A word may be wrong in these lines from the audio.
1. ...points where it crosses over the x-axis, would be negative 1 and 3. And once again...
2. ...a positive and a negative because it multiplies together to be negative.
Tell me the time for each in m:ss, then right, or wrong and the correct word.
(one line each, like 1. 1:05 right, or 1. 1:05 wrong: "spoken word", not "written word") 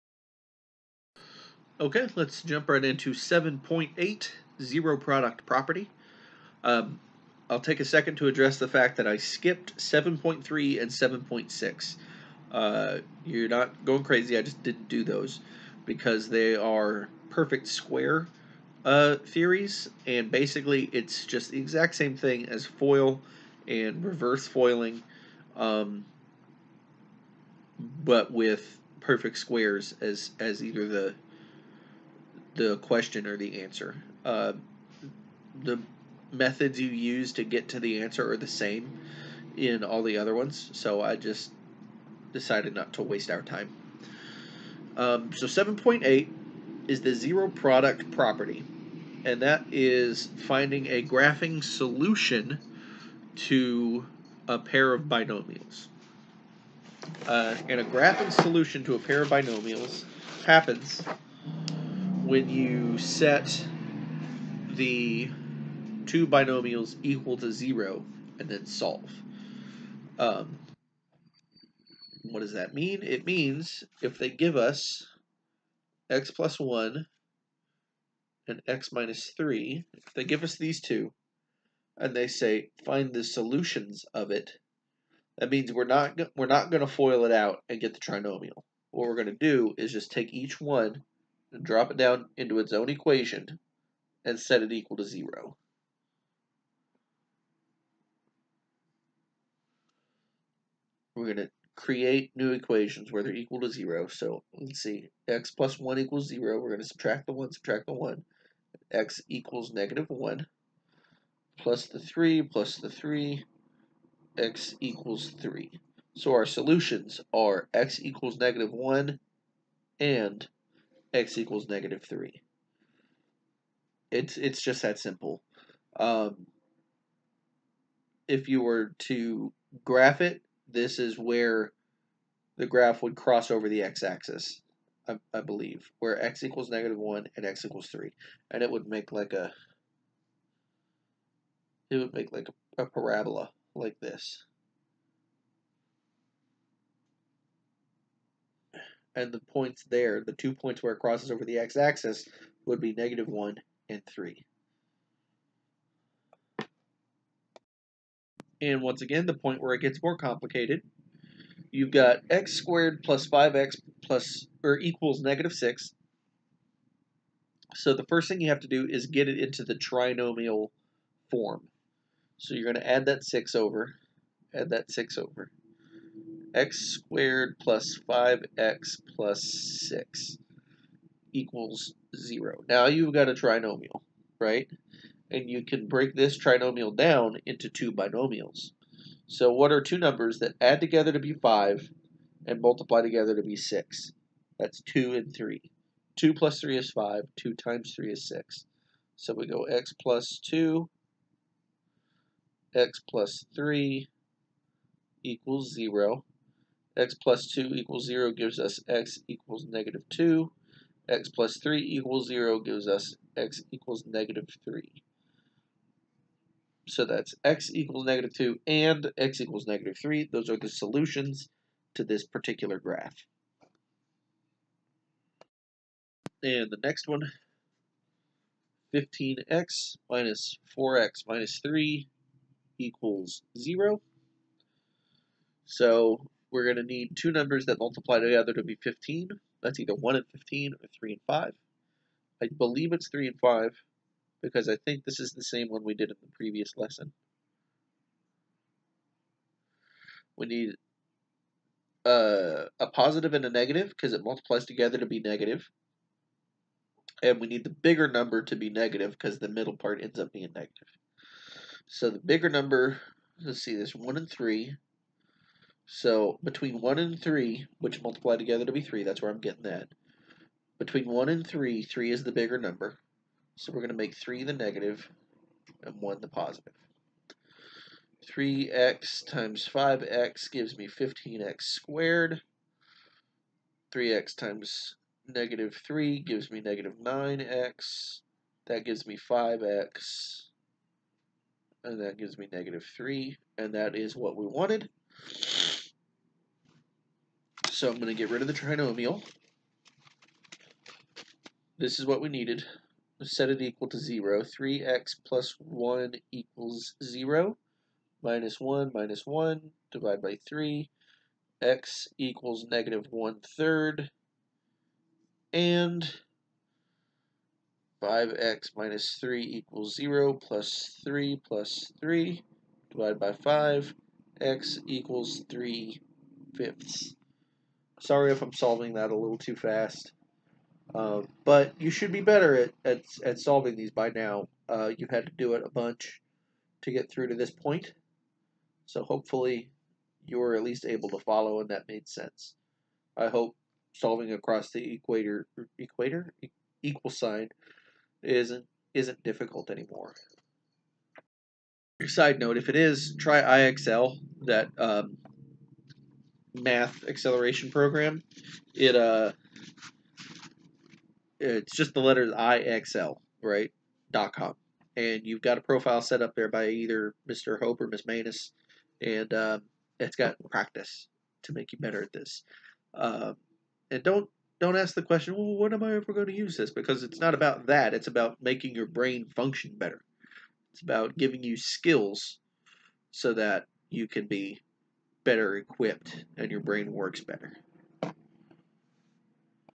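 1. 2:30 right
2. 4:12 right.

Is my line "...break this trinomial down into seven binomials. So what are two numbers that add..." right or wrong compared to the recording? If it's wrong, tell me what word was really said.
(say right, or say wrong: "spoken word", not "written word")
wrong: "two", not "seven".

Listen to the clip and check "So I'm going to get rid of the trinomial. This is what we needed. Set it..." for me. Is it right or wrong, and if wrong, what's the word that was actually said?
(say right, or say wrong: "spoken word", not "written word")
right.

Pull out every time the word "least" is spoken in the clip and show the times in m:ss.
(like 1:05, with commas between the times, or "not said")
5:40.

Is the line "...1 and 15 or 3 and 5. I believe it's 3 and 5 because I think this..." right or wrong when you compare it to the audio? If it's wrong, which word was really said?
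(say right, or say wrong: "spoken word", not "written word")
right.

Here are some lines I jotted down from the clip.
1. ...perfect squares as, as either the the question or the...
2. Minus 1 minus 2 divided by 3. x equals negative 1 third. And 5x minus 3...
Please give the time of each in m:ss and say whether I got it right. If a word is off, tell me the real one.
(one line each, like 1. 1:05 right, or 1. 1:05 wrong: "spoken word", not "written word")
1. 0:28 right
2. 5:08 wrong: "1", not "2".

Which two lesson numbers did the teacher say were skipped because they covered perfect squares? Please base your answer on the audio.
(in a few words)
7.3 and 7.6.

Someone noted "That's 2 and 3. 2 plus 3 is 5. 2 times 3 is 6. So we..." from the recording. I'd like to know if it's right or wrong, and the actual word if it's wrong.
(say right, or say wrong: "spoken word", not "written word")
right.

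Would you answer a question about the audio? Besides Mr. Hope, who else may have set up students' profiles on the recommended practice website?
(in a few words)
Miss Manus.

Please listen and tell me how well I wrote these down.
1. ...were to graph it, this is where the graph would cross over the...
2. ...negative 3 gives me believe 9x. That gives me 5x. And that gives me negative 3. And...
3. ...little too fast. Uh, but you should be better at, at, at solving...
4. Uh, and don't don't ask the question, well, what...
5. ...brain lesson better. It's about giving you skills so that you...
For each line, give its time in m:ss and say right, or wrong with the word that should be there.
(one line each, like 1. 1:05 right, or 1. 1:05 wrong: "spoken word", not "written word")
1. 2:08 right
2. 4:45 wrong: "negative", not "believe"
3. 5:29 right
4. 6:12 right
5. 6:18 wrong: "function", not "lesson".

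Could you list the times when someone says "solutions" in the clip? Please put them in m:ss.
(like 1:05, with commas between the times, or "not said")
0:51, 0:58, 1:23, 1:56, 3:40.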